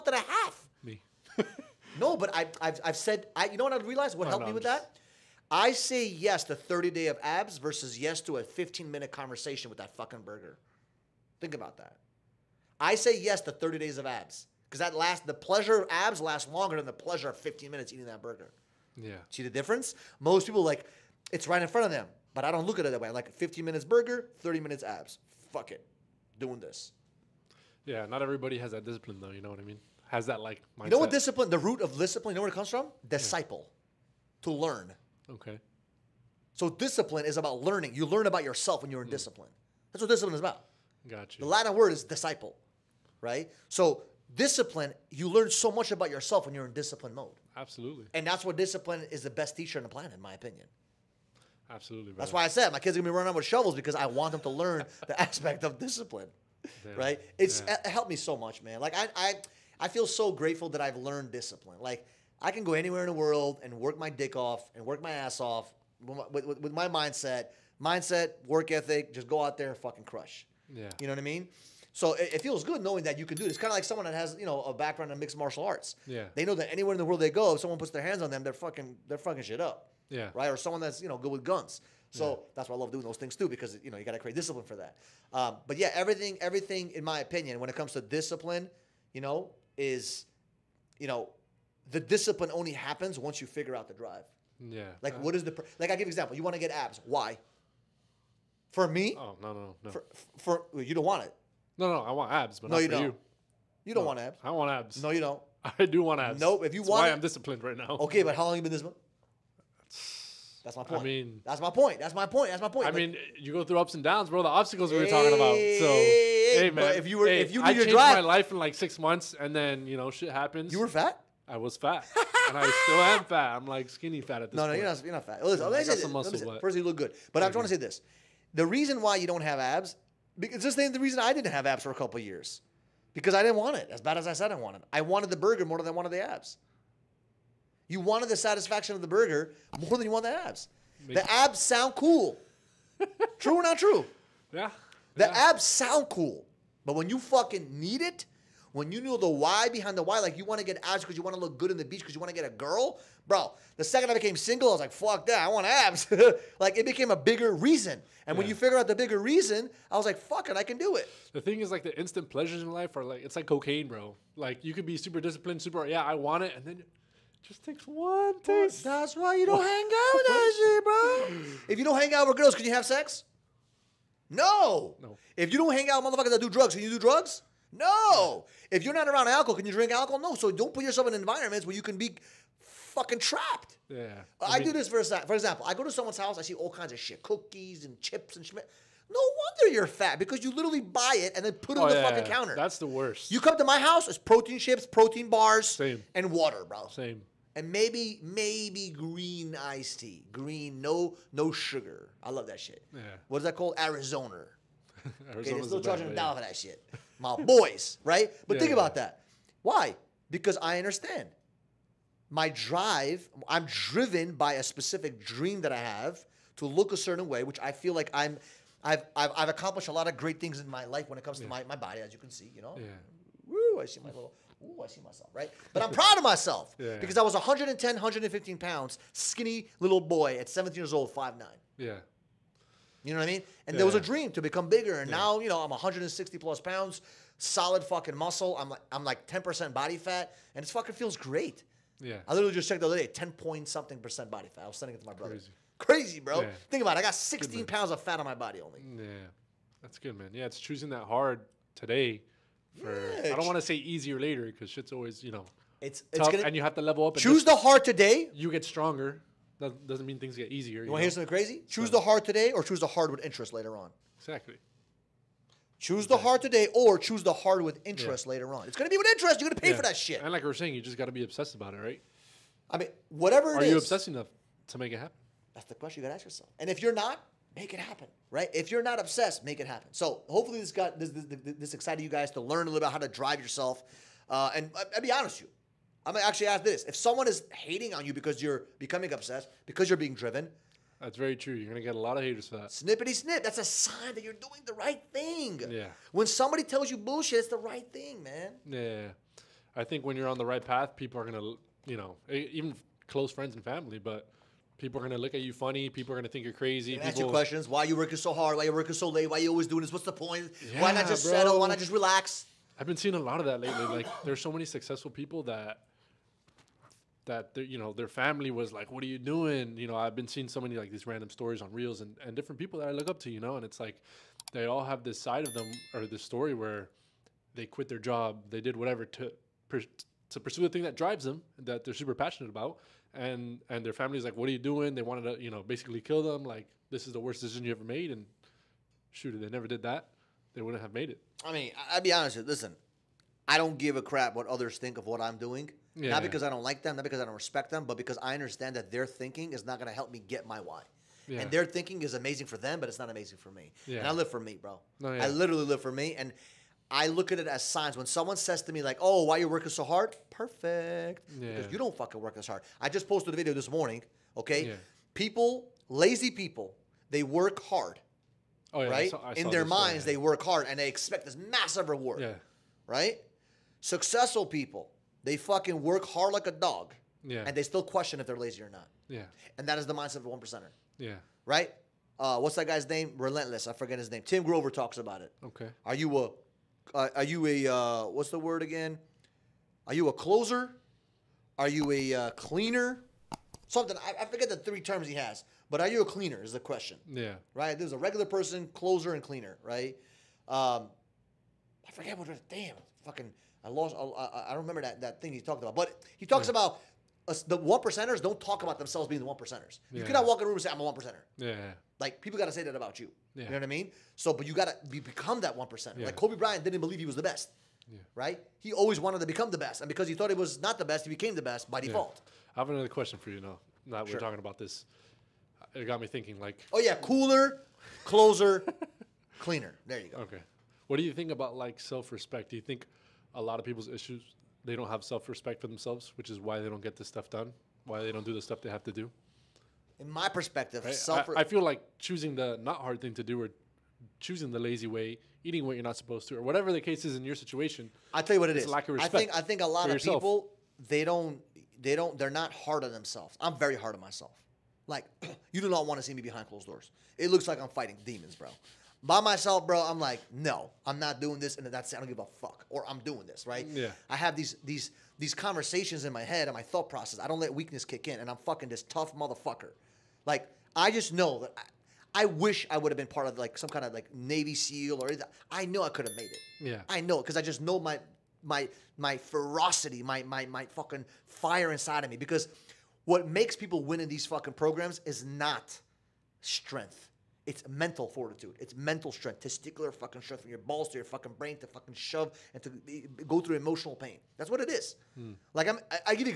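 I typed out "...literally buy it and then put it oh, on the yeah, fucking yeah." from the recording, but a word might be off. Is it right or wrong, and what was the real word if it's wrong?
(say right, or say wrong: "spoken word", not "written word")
right.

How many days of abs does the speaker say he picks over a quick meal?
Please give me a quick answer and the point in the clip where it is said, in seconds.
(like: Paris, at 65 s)
30, at 6 s.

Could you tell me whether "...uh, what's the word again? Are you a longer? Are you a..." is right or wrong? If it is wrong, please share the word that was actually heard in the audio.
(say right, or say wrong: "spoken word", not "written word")
wrong: "closer", not "longer".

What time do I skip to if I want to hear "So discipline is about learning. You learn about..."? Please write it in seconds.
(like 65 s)
36 s.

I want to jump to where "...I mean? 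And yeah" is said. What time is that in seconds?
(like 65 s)
233 s.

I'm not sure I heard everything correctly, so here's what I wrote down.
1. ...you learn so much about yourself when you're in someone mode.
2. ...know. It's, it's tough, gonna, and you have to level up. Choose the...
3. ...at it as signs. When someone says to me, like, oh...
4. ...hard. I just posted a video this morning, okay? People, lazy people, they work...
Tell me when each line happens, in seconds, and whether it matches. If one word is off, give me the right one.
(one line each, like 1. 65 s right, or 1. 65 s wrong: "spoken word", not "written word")
1. 45 s wrong: "discipline", not "someone"
2. 255 s right
3. 357 s right
4. 362 s right.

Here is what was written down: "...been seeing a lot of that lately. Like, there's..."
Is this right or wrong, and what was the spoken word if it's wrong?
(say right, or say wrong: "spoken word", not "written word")
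right.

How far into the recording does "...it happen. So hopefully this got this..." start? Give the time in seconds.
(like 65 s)
279 s.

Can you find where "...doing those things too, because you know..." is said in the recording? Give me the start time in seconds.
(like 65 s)
82 s.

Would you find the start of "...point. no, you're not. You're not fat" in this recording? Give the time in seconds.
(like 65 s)
124 s.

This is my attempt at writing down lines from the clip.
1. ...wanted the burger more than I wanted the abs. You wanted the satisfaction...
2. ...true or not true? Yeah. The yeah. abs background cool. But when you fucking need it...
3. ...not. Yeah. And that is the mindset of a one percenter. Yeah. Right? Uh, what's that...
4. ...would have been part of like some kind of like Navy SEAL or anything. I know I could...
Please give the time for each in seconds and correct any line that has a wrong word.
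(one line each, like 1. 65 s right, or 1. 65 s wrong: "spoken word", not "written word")
1. 135 s right
2. 143 s wrong: "sound", not "background"
3. 378 s right
4. 472 s right.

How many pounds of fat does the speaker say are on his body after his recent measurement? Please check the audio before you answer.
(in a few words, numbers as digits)
16.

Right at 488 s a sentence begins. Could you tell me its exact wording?
It's mental strength, testicular fucking strength from your balls to your fucking brain to fucking shove and to go through emotional pain.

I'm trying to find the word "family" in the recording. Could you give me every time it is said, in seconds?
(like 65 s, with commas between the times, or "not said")
303 s, 318 s, 333 s.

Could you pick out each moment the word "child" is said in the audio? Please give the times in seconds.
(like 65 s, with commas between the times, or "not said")
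not said.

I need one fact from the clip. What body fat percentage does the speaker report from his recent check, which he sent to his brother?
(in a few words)
10%.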